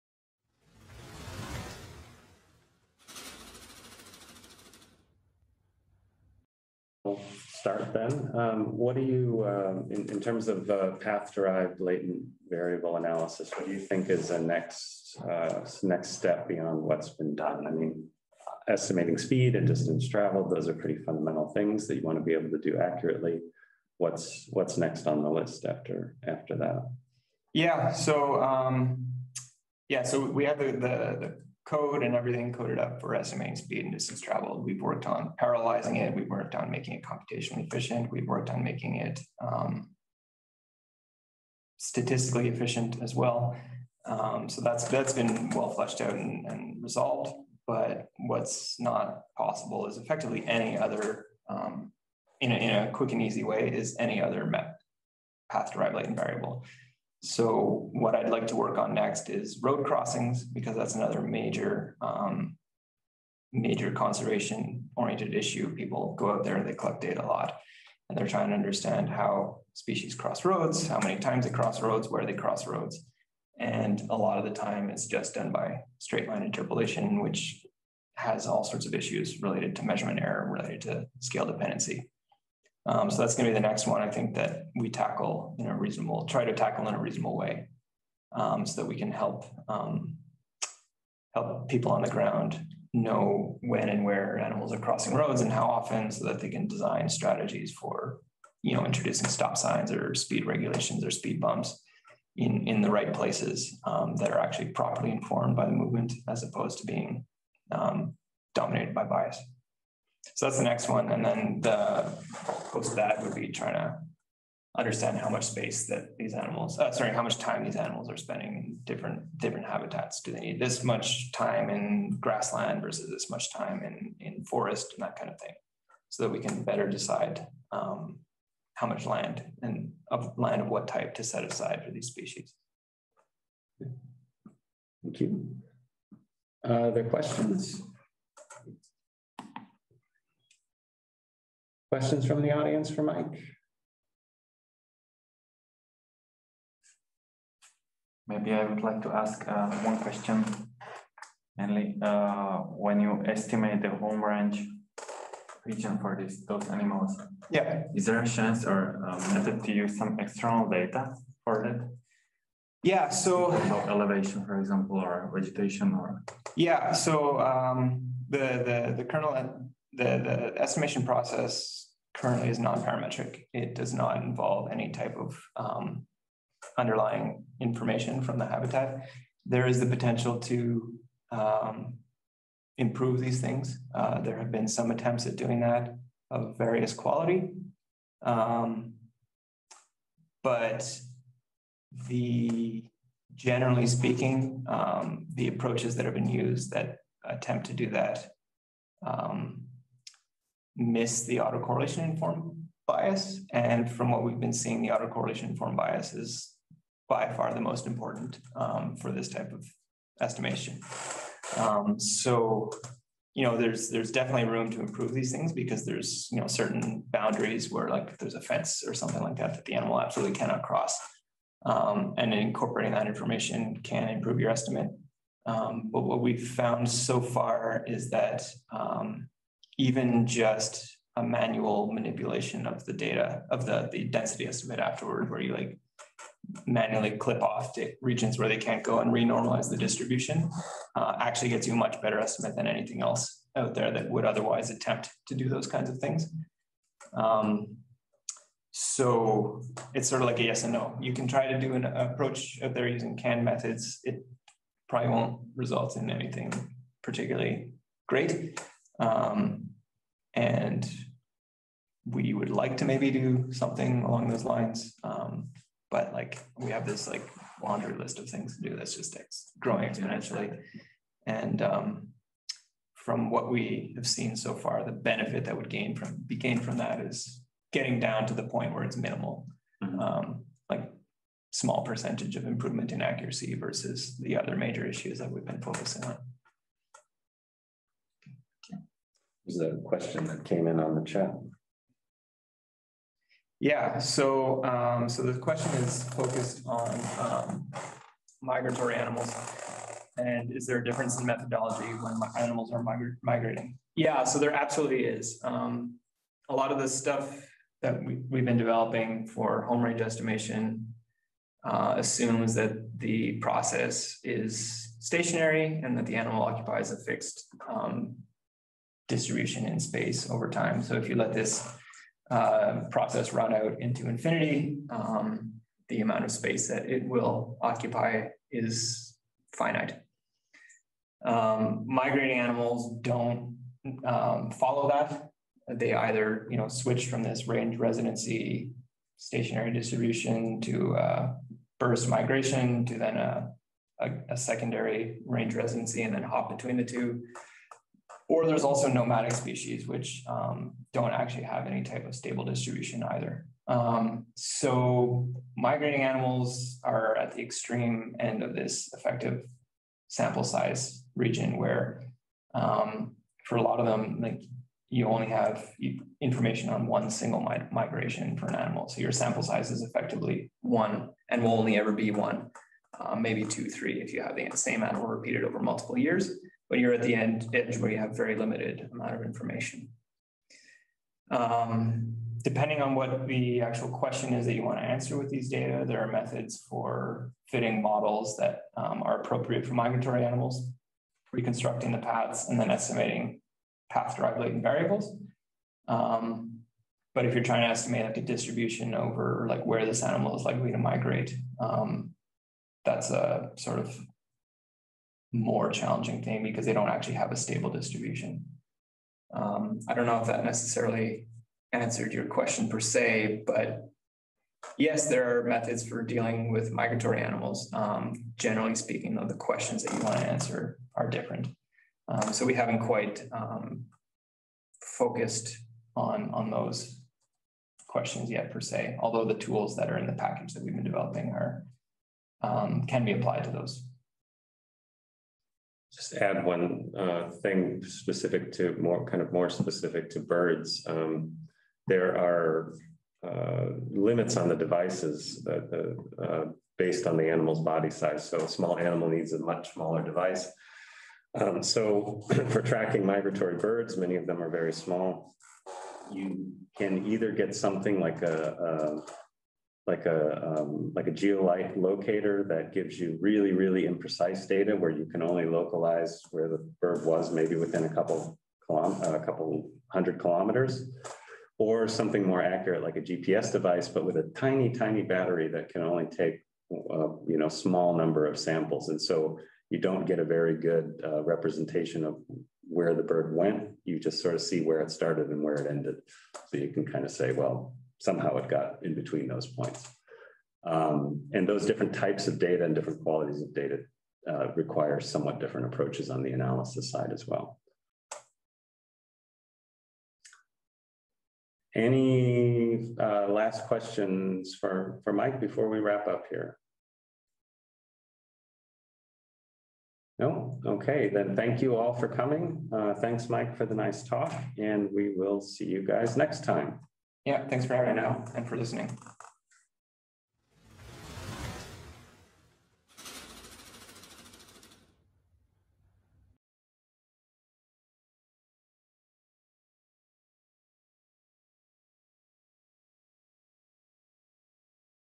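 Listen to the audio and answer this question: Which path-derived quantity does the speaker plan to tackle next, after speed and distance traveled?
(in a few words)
Road crossings.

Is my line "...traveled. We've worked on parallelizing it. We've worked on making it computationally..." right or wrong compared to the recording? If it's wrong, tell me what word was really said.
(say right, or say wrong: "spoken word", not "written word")
right.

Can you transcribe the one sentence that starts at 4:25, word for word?
Um, but like we have this like laundry list of things to do that's just ex- growing exponentially.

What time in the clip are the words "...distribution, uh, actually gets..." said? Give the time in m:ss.
3:59.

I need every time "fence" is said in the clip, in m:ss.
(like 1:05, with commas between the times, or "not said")
3:38.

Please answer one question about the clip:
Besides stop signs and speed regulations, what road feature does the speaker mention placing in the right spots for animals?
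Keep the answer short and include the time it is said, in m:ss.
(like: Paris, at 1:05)
Speed bumps, at 1:41.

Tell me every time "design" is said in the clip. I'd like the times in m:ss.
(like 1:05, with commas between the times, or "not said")
1:36.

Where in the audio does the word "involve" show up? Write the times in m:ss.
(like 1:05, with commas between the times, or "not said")
2:54.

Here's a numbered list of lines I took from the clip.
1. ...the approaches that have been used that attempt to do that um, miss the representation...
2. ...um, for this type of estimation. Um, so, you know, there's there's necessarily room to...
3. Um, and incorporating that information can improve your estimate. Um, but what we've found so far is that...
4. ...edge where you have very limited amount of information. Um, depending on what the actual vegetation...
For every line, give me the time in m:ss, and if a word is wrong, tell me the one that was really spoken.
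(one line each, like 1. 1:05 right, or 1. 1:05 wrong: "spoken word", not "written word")
1. 3:15 wrong: "autocorrelation", not "representation"
2. 3:28 wrong: "definitely", not "necessarily"
3. 3:41 right
4. 6:17 wrong: "question", not "vegetation".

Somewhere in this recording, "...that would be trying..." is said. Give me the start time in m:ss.
1:52.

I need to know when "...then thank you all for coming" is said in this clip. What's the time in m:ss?
8:31.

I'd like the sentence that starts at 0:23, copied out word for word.
What's, what's next on the list after, after that?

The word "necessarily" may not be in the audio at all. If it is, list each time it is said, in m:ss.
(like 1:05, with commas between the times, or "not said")
6:50.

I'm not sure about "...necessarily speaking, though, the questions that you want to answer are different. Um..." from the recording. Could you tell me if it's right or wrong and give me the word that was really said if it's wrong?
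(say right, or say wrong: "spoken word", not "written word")
wrong: "generally", not "necessarily".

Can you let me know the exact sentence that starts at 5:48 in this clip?
Or there's also nomadic species, which um, don't actually have any type of stable distribution either.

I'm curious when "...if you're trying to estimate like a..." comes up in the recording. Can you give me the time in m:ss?
6:37.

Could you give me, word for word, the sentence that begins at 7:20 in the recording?
Um, there are uh, limits on the devices that, uh, uh based on the animal's body size.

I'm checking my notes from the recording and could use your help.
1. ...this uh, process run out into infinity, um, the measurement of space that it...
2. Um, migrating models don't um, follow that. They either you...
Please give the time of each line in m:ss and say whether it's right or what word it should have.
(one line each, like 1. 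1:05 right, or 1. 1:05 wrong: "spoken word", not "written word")
1. 5:21 wrong: "amount", not "measurement"
2. 5:31 wrong: "animals", not "models".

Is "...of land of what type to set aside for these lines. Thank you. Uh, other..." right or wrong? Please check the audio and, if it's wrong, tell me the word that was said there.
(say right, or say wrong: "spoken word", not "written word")
wrong: "species", not "lines".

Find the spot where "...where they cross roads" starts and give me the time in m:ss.
1:12.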